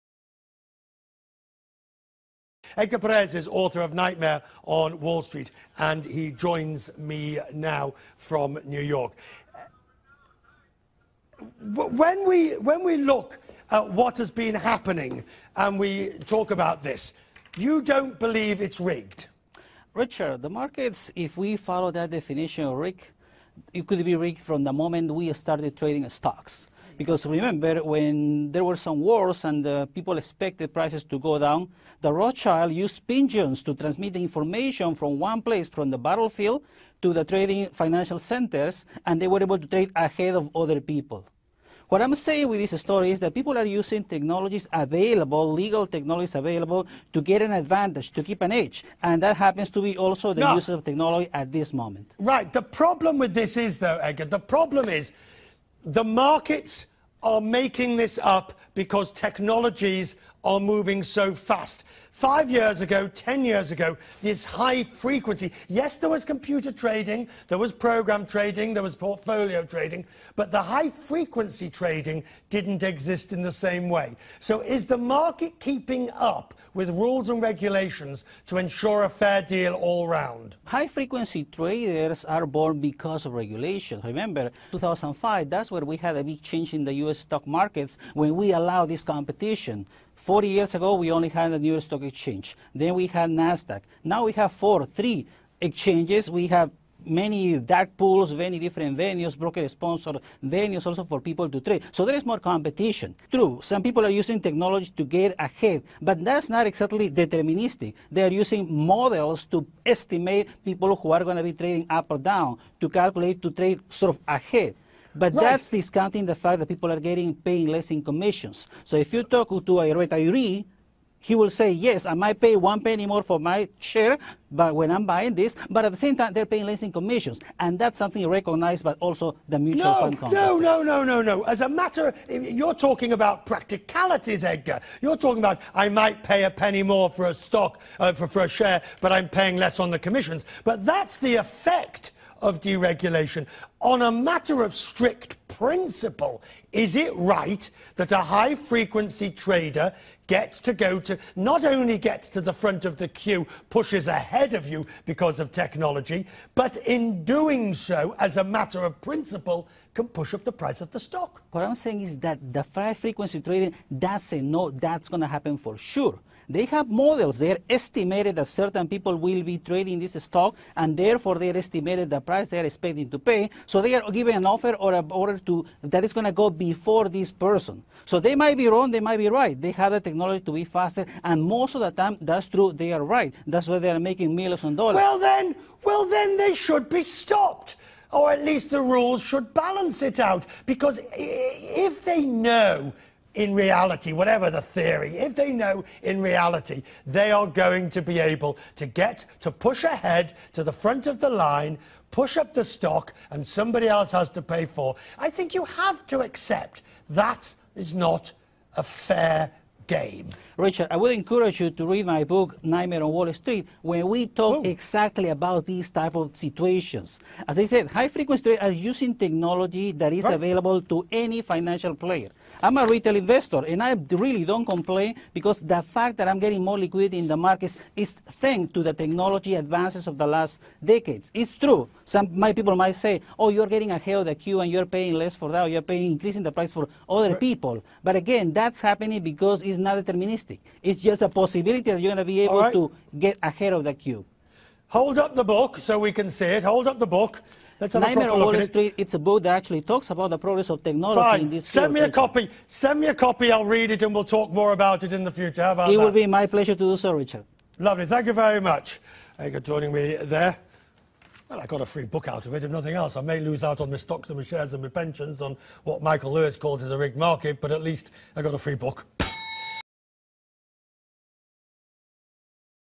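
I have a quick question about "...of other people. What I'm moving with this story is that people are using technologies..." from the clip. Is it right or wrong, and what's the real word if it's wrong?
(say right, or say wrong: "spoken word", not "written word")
wrong: "saying", not "moving".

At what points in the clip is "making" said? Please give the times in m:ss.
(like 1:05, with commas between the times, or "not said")
0:57, 3:03.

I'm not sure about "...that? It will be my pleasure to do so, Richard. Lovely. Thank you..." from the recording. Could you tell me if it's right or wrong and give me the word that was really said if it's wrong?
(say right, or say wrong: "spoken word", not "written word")
right.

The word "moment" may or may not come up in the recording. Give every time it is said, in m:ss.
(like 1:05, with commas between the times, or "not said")
0:24, 0:51.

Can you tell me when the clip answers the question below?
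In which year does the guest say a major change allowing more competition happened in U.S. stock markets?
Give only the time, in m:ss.
1:24.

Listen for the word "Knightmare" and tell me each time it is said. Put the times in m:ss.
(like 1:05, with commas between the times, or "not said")
0:03, 3:32, 4:08.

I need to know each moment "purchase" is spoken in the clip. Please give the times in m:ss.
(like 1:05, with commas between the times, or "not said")
not said.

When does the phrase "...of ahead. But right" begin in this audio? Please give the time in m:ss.
1:54.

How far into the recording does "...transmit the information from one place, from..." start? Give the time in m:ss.
0:33.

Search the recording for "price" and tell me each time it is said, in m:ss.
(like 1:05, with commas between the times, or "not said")
0:30, 2:40, 2:52, 3:56.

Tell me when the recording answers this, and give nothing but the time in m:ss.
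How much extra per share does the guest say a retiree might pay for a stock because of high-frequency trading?
2:02.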